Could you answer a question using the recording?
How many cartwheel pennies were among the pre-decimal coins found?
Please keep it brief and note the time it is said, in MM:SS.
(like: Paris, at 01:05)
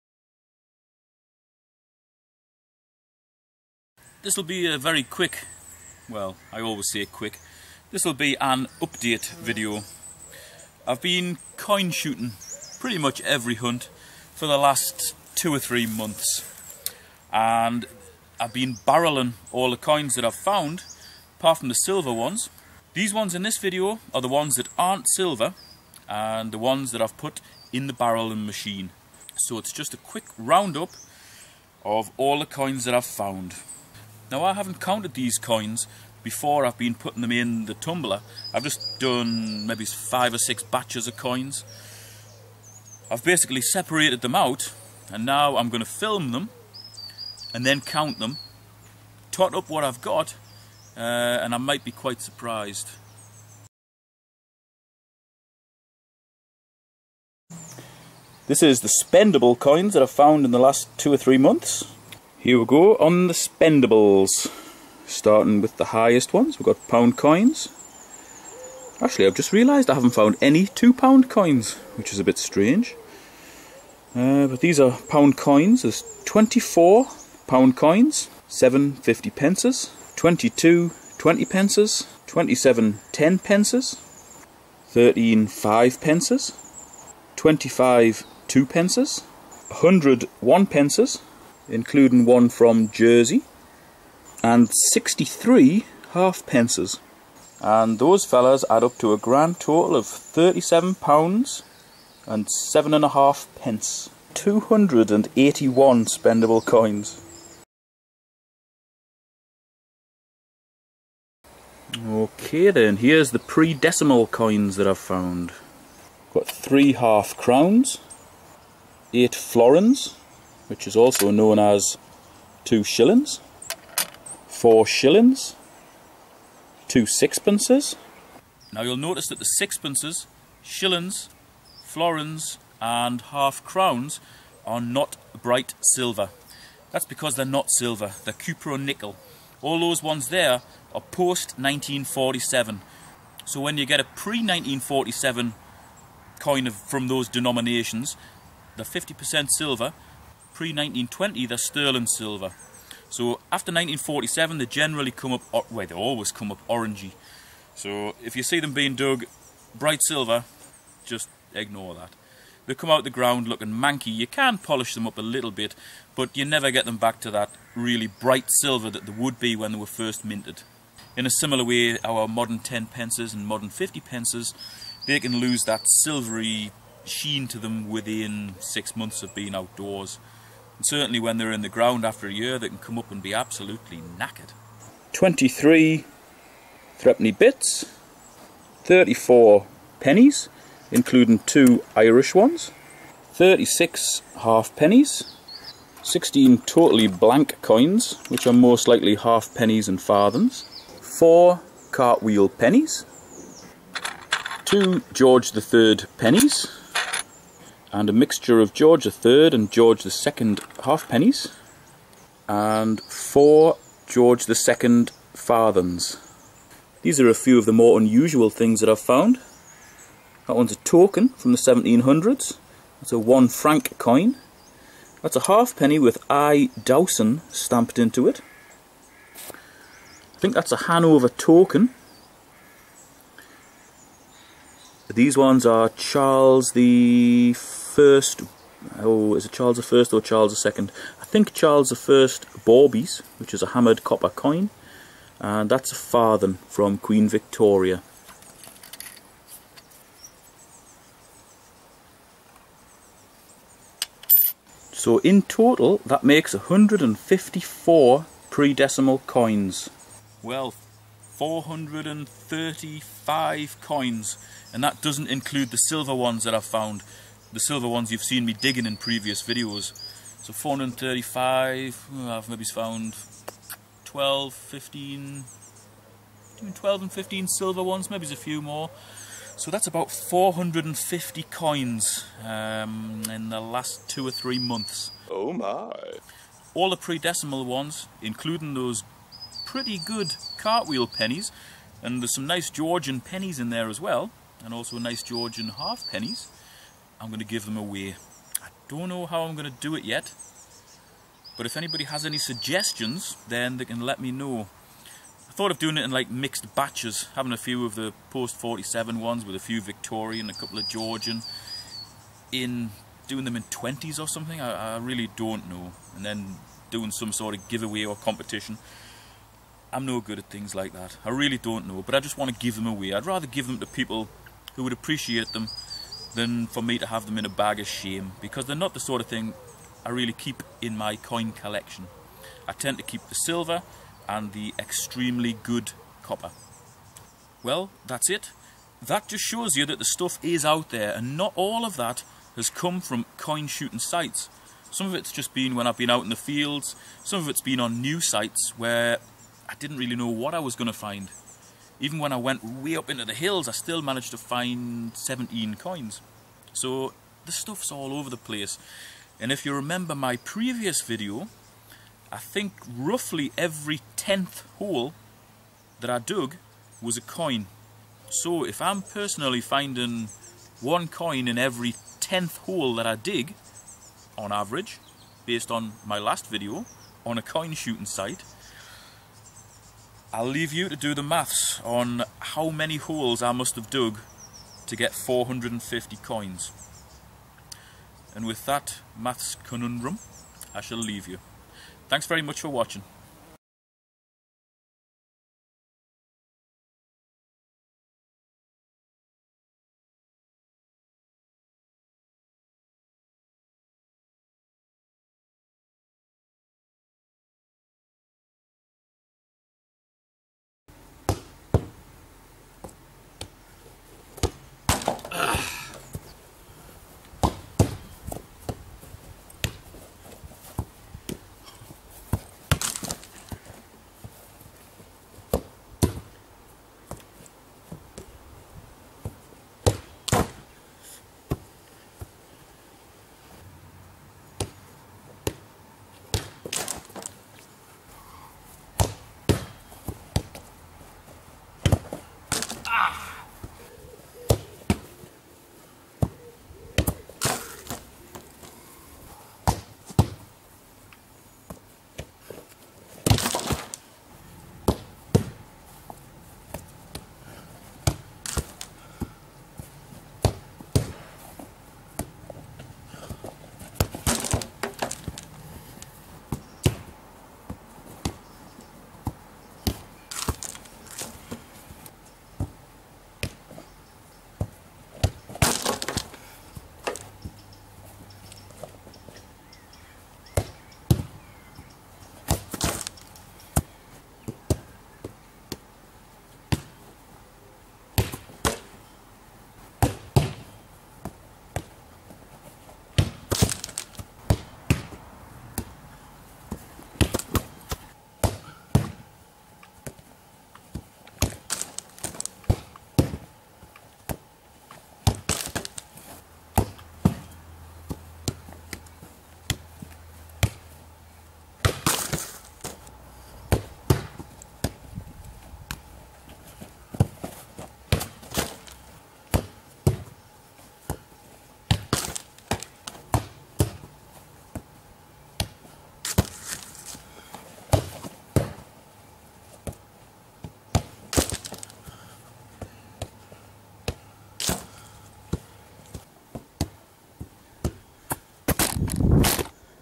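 4, at 03:21.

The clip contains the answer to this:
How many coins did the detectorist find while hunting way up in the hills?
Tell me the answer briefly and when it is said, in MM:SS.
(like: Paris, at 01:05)
17, at 05:55.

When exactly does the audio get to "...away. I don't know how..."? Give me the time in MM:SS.
04:57.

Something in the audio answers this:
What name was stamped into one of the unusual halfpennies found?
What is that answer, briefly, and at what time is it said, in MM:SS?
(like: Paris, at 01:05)
I. Dowson, at 03:46.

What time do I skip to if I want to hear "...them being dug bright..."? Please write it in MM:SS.
02:38.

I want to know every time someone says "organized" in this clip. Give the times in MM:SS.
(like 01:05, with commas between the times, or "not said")
not said.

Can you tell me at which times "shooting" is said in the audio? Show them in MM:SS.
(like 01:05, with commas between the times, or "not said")
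00:11, 05:43, 06:17.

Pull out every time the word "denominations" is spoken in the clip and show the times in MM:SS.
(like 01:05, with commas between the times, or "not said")
02:27.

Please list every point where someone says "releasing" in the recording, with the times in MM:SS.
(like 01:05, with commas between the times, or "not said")
not said.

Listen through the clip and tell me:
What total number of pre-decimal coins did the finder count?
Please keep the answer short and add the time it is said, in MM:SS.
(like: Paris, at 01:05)
154, at 04:16.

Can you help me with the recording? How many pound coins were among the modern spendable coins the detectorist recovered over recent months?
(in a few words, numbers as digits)
24.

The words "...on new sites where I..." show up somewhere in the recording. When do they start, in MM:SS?
05:47.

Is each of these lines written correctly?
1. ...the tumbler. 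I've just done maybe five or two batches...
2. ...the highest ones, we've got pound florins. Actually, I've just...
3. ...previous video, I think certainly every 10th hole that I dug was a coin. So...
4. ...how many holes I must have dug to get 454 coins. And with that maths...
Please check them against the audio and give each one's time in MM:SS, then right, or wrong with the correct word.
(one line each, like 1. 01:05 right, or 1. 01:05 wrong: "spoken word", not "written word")
1. 00:37 wrong: "six", not "two"
2. 01:05 wrong: "coins", not "florins"
3. 06:00 wrong: "roughly", not "certainly"
4. 06:22 wrong: "450", not "454".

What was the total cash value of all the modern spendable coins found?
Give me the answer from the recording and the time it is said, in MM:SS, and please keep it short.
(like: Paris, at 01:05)
£37 and 7.5p, at 01:40.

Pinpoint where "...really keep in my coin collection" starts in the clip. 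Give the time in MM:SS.
05:30.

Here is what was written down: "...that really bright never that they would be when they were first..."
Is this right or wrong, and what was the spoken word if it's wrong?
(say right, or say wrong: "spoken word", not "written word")
wrong: "silver", not "never".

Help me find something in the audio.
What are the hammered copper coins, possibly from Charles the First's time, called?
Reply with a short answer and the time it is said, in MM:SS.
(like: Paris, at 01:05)
Bawbees, at 04:02.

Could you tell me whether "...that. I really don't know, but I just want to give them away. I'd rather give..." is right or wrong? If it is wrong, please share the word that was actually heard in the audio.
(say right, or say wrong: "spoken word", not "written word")
right.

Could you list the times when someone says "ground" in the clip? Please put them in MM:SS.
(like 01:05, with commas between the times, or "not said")
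02:43, 03:01.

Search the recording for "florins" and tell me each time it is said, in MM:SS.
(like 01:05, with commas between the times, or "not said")
01:59, 02:11.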